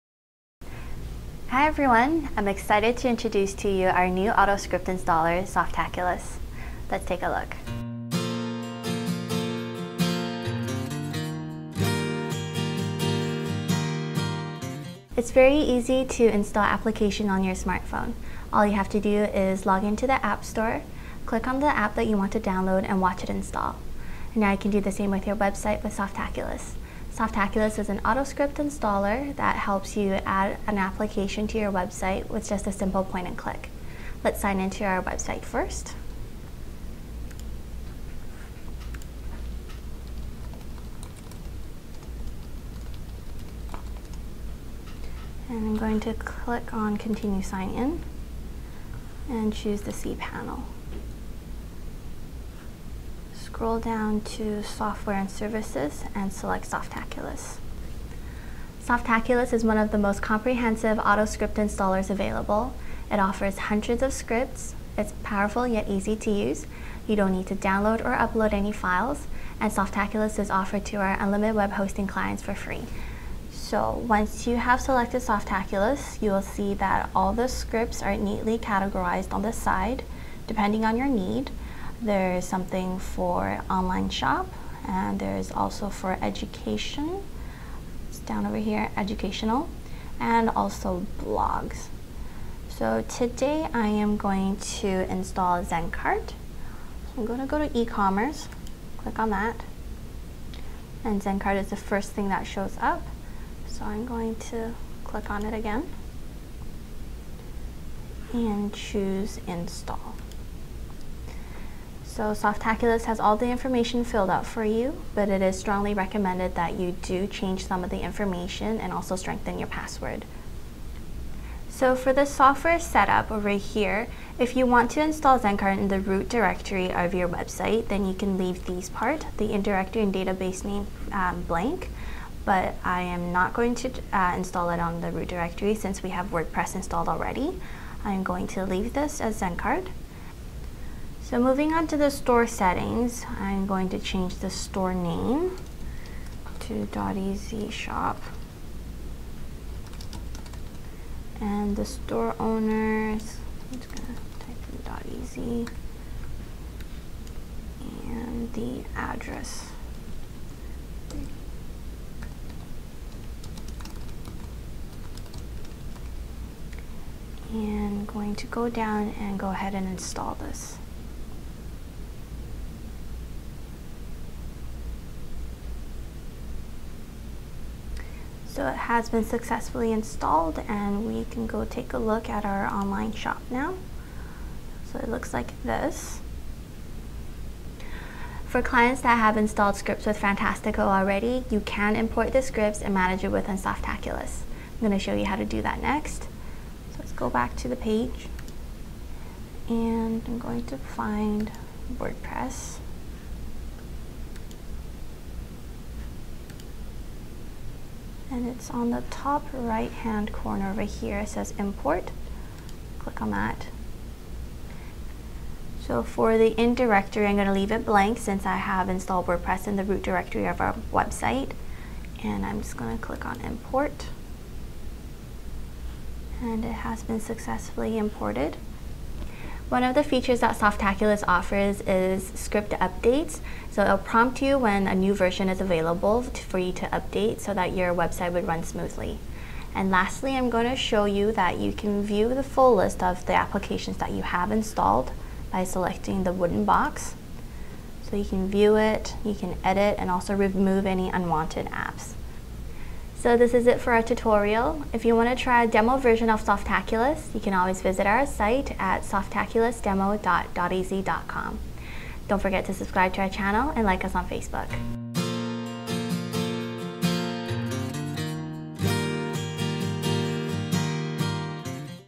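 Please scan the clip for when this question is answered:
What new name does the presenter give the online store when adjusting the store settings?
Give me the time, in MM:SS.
02:27.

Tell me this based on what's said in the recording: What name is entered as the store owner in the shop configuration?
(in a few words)
Doteasy.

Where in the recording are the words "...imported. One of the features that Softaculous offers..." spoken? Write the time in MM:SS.
03:47.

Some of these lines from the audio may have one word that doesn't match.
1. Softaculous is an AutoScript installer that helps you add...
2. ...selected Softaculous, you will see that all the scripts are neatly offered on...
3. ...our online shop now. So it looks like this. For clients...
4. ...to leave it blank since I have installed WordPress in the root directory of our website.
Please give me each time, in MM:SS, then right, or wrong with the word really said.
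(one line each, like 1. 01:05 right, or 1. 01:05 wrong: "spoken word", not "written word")
1. 00:27 right
2. 01:14 wrong: "categorized", not "offered"
3. 03:02 right
4. 03:37 right.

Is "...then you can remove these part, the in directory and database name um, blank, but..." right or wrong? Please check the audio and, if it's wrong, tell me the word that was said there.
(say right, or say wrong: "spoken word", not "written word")
wrong: "leave", not "remove".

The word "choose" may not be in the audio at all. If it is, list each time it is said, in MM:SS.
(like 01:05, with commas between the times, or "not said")
00:49, 01:48.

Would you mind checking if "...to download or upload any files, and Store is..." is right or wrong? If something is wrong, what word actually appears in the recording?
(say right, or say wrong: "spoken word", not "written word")
wrong: "Softaculous", not "Store".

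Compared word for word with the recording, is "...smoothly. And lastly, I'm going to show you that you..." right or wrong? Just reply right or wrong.
right.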